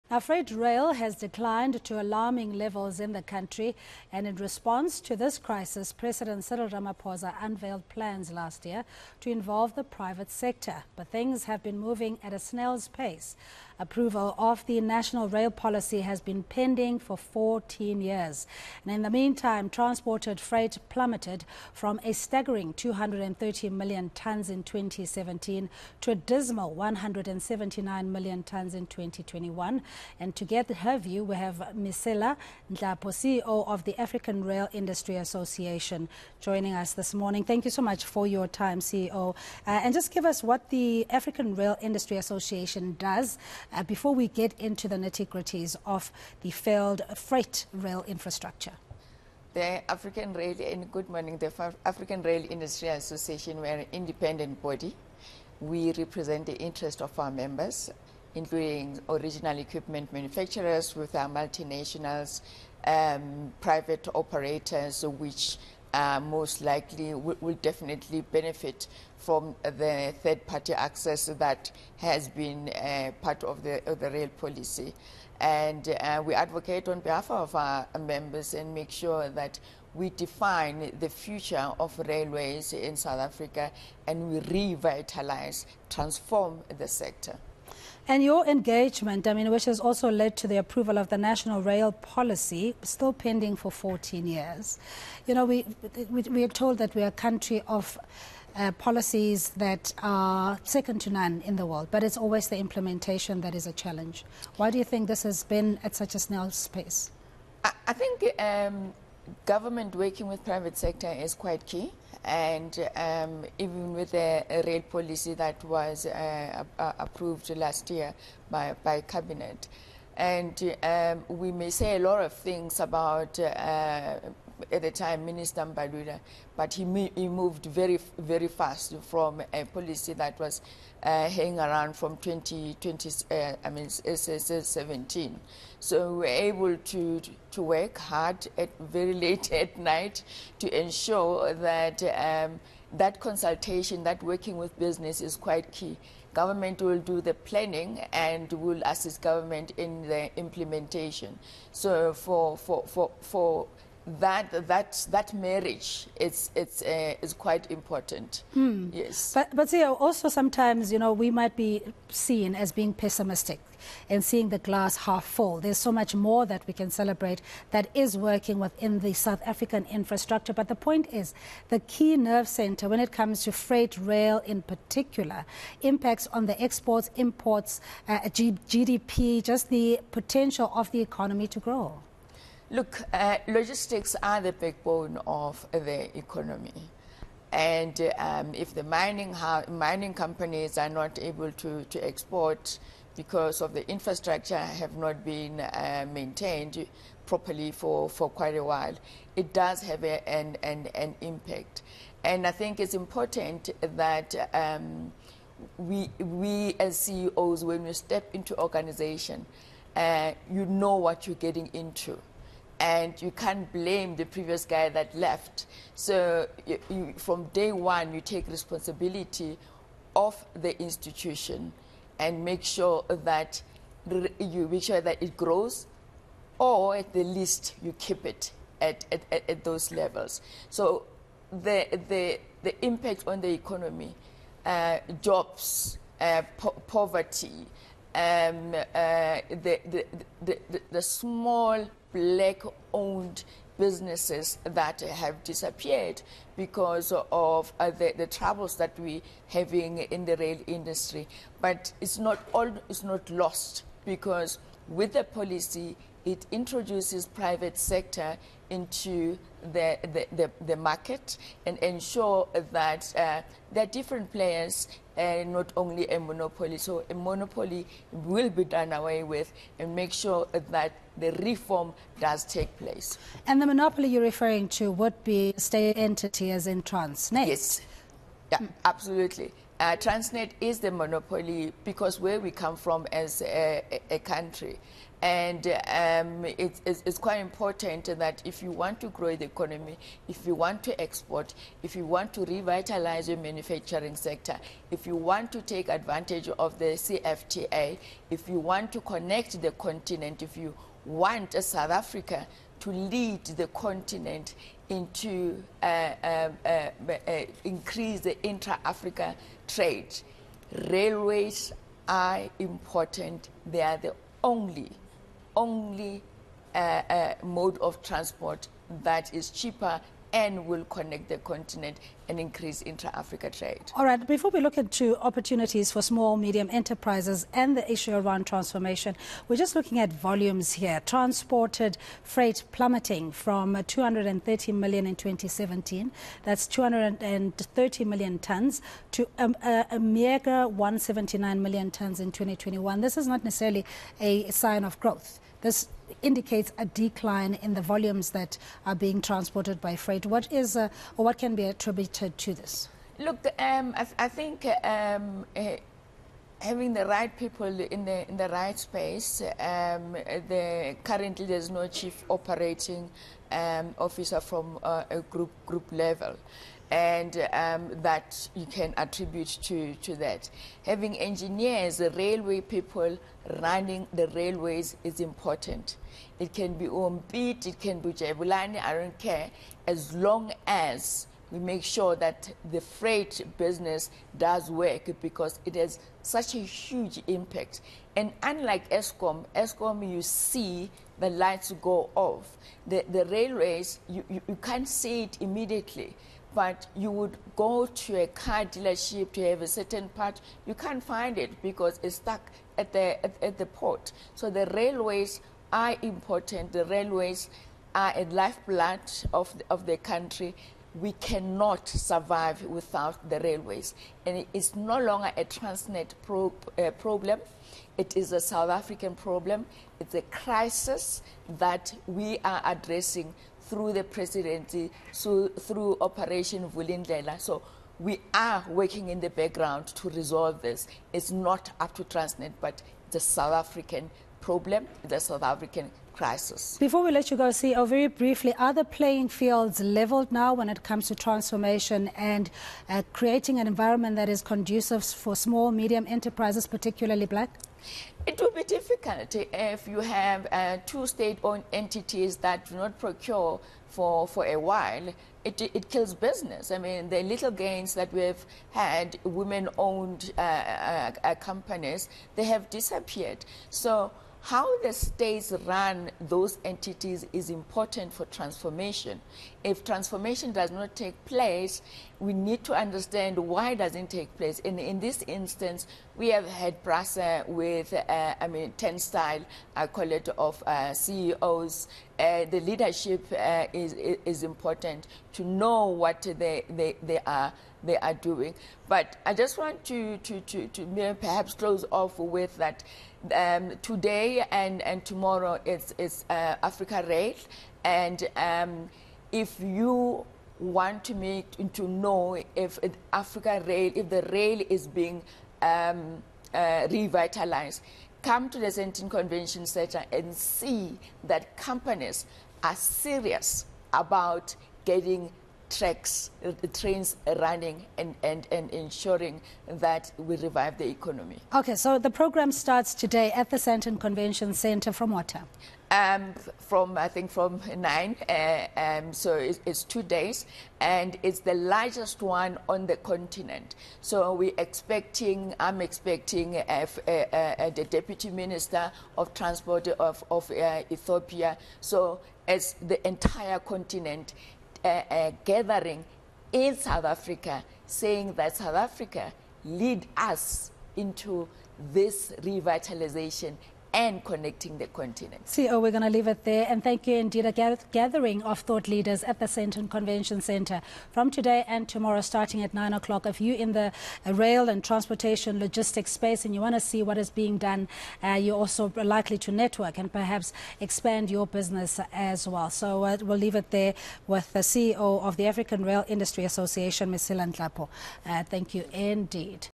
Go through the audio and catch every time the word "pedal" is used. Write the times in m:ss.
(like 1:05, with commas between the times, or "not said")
not said.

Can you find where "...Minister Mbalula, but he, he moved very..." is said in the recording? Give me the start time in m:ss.
2:05.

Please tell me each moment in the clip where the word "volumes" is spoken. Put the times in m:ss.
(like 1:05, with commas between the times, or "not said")
5:30, 5:47.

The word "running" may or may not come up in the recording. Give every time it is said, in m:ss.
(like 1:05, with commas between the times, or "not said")
6:13, 8:37.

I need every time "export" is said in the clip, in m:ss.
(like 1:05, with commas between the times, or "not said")
2:56, 3:11, 4:51.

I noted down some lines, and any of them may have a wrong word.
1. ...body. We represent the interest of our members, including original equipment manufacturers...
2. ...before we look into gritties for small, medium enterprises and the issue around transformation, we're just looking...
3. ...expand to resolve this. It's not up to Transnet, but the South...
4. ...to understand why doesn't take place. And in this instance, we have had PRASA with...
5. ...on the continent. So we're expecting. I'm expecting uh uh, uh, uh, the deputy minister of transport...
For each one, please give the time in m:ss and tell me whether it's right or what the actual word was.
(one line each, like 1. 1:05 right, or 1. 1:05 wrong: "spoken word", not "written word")
1. 0:54 right
2. 5:24 wrong: "opportunities", not "gritties"
3. 7:09 wrong: "background", not "expand"
4. 7:52 right
5. 8:52 right.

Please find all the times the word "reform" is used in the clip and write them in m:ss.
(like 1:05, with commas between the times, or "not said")
4:31.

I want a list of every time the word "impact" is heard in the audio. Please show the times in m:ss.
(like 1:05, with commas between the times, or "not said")
2:55, 3:21, 3:52, 6:27.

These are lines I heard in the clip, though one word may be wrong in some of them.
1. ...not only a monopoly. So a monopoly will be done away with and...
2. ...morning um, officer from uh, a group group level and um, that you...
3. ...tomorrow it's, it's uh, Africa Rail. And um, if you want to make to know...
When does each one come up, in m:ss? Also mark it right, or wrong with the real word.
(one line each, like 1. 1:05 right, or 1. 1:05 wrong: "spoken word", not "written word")
1. 4:25 right
2. 6:02 wrong: "operating", not "morning"
3. 8:15 right.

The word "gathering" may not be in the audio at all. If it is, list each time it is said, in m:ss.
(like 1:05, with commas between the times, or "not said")
9:05, 9:17.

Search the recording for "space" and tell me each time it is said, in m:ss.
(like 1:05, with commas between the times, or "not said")
5:58, 9:26.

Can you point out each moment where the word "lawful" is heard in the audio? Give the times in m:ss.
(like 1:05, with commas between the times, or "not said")
not said.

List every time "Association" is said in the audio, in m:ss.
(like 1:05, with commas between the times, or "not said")
0:35, 0:42, 0:52, 9:36.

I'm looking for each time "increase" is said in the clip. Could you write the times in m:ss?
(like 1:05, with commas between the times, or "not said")
5:07, 5:22.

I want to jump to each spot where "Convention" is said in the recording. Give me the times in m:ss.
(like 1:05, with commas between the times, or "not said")
8:29, 8:43, 9:19.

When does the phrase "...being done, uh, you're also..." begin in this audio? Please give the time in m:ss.
9:27.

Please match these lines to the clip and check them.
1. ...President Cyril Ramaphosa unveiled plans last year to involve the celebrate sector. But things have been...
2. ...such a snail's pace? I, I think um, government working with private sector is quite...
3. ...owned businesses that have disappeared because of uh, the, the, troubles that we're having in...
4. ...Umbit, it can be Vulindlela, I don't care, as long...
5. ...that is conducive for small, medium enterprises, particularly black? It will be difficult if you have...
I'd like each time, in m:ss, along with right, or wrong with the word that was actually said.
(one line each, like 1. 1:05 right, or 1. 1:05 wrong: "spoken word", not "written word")
1. 0:05 wrong: "private", not "celebrate"
2. 1:45 right
3. 4:02 right
4. 6:16 wrong: "Jabulani", not "Vulindlela"
5. 7:24 right.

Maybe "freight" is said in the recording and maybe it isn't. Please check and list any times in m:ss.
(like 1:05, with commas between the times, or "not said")
0:00, 0:20, 0:47, 2:53, 5:32, 5:49, 6:22.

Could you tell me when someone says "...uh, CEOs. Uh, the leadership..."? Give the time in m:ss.
8:00.